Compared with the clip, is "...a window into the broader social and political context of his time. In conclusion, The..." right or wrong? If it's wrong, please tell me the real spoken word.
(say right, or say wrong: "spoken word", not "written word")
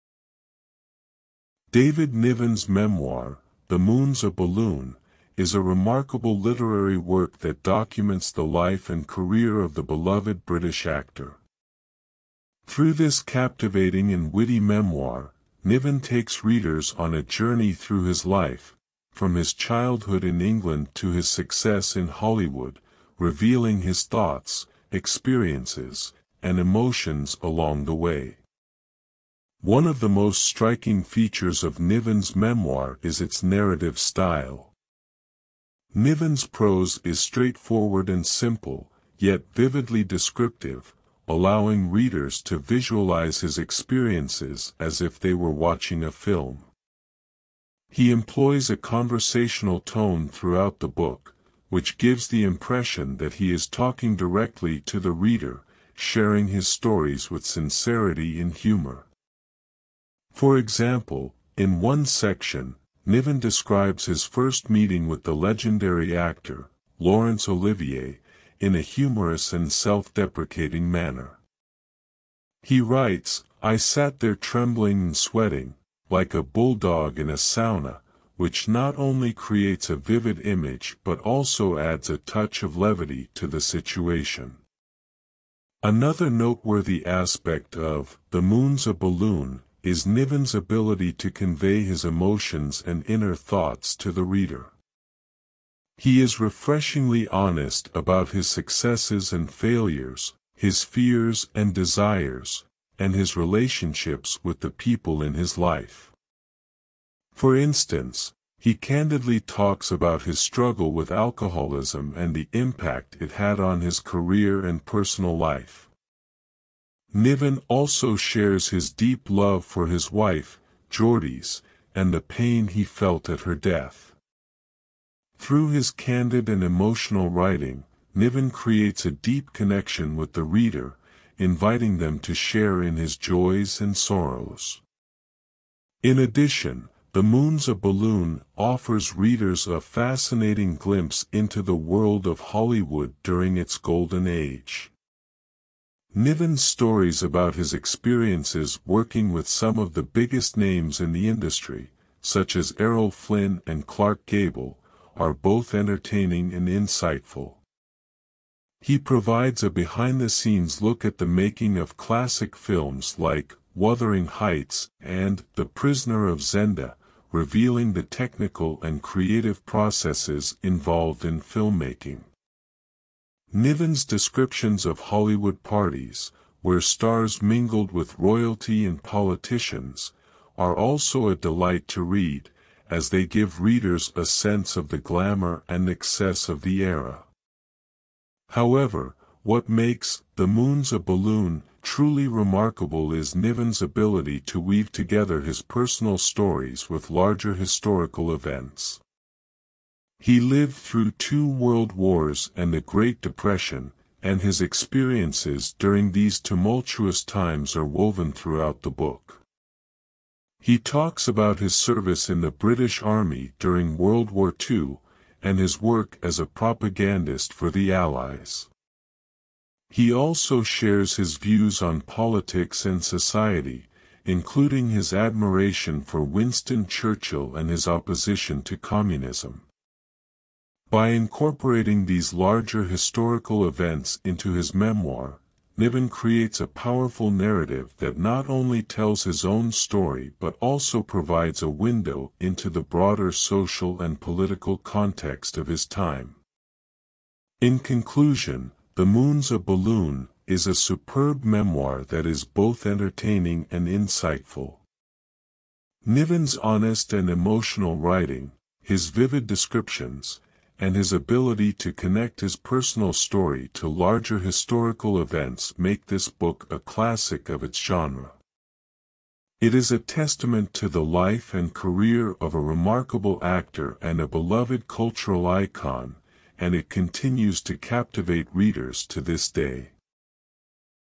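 right.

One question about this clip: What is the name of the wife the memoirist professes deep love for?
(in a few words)
Hjordis.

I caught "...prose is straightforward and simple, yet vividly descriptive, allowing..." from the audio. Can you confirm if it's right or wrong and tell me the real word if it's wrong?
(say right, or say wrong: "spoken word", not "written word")
right.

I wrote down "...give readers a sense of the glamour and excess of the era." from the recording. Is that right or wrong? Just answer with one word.
right.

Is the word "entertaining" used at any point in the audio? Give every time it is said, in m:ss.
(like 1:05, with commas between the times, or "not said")
2:35, 4:12.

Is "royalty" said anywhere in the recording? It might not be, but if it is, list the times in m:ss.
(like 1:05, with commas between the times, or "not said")
2:58.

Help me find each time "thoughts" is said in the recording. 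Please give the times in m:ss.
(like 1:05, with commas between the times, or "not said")
0:24, 1:33.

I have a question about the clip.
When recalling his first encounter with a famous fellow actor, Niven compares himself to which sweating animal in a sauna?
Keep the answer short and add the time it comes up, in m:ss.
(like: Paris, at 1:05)
bulldog, at 1:16.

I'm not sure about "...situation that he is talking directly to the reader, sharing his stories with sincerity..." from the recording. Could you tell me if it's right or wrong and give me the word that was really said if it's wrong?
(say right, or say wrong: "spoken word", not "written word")
wrong: "impression", not "situation".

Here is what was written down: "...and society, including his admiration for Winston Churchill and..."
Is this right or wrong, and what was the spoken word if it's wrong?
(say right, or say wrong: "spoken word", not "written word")
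right.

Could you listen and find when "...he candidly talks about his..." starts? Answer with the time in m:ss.
1:48.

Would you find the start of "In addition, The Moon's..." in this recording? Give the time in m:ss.
2:16.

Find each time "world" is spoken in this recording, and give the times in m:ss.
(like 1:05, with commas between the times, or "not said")
2:21, 3:21, 3:33.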